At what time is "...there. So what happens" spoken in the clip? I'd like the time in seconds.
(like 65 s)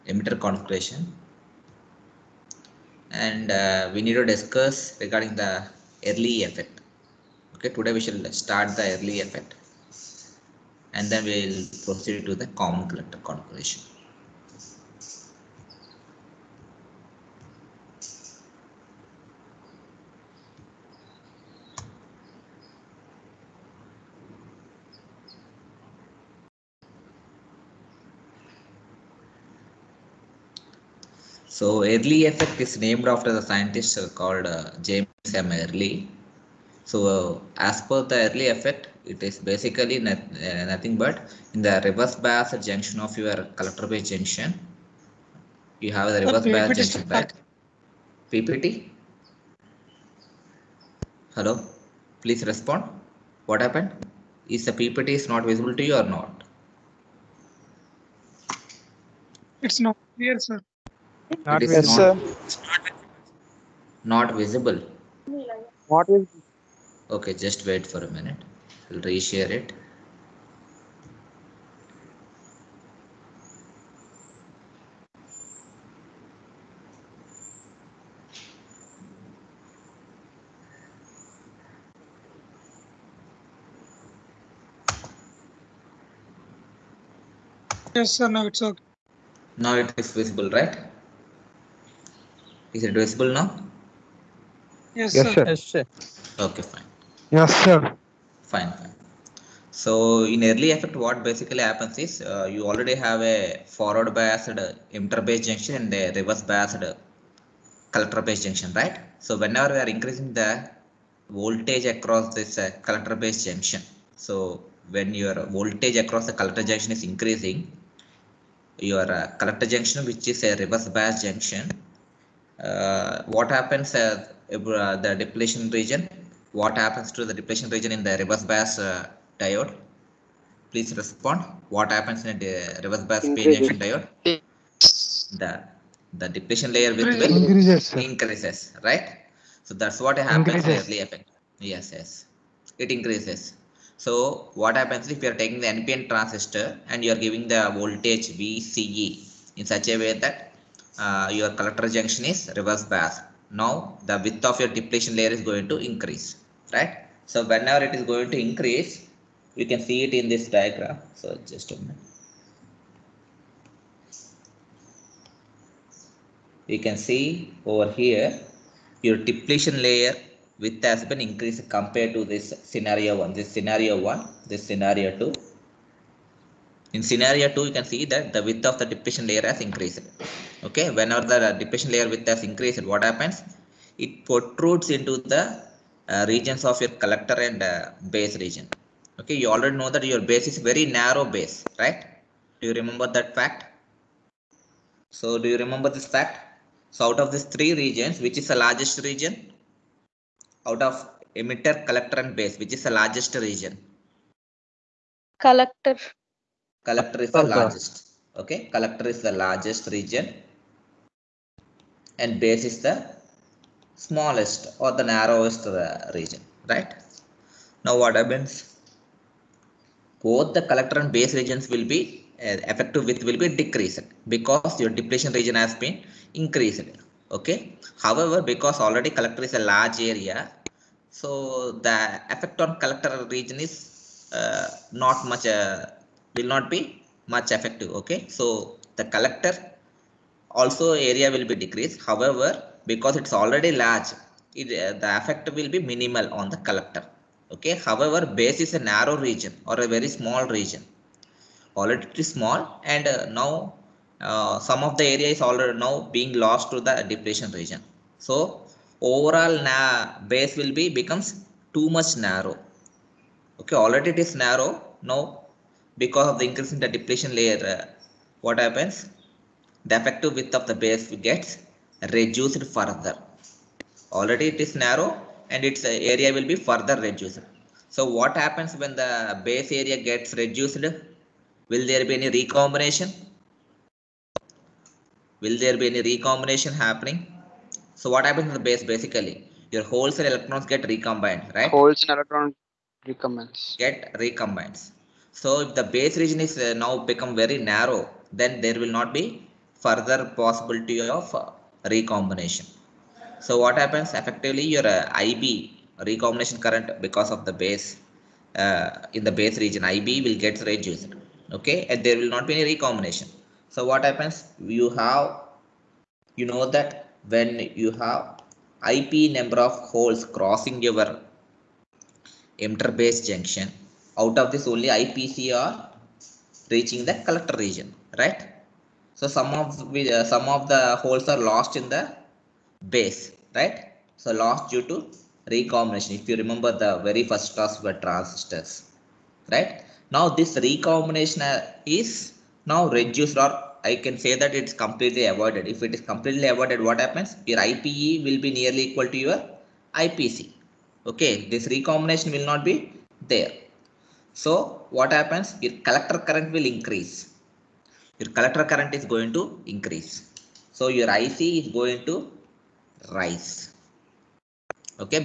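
353 s.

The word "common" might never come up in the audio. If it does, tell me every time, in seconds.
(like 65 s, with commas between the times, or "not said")
12 s.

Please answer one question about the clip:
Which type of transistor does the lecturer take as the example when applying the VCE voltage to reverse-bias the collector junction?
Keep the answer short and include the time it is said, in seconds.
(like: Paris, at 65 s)
NPN, at 145 s.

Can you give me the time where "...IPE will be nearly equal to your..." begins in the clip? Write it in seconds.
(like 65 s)
347 s.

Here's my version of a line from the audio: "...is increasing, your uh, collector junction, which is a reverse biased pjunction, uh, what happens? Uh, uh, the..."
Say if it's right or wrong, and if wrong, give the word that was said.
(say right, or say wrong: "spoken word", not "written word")
wrong: "junction", not "pjunction".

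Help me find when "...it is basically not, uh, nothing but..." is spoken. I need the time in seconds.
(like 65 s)
39 s.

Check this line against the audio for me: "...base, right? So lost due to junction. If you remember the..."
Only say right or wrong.
wrong.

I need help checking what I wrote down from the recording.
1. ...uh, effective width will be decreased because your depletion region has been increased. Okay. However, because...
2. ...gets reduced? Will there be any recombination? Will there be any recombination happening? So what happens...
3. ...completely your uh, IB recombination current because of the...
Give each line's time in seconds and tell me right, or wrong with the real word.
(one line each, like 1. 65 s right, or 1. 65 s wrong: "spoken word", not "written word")
1. 222 s right
2. 280 s right
3. 304 s wrong: "effectively", not "completely".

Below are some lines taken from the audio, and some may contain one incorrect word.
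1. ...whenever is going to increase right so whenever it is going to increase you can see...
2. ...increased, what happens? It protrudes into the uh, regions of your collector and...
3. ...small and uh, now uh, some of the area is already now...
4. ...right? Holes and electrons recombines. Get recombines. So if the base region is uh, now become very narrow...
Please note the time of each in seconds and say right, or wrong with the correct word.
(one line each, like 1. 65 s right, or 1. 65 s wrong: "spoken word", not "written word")
1. 155 s wrong: "layer", not "whenever"
2. 182 s right
3. 252 s right
4. 291 s right.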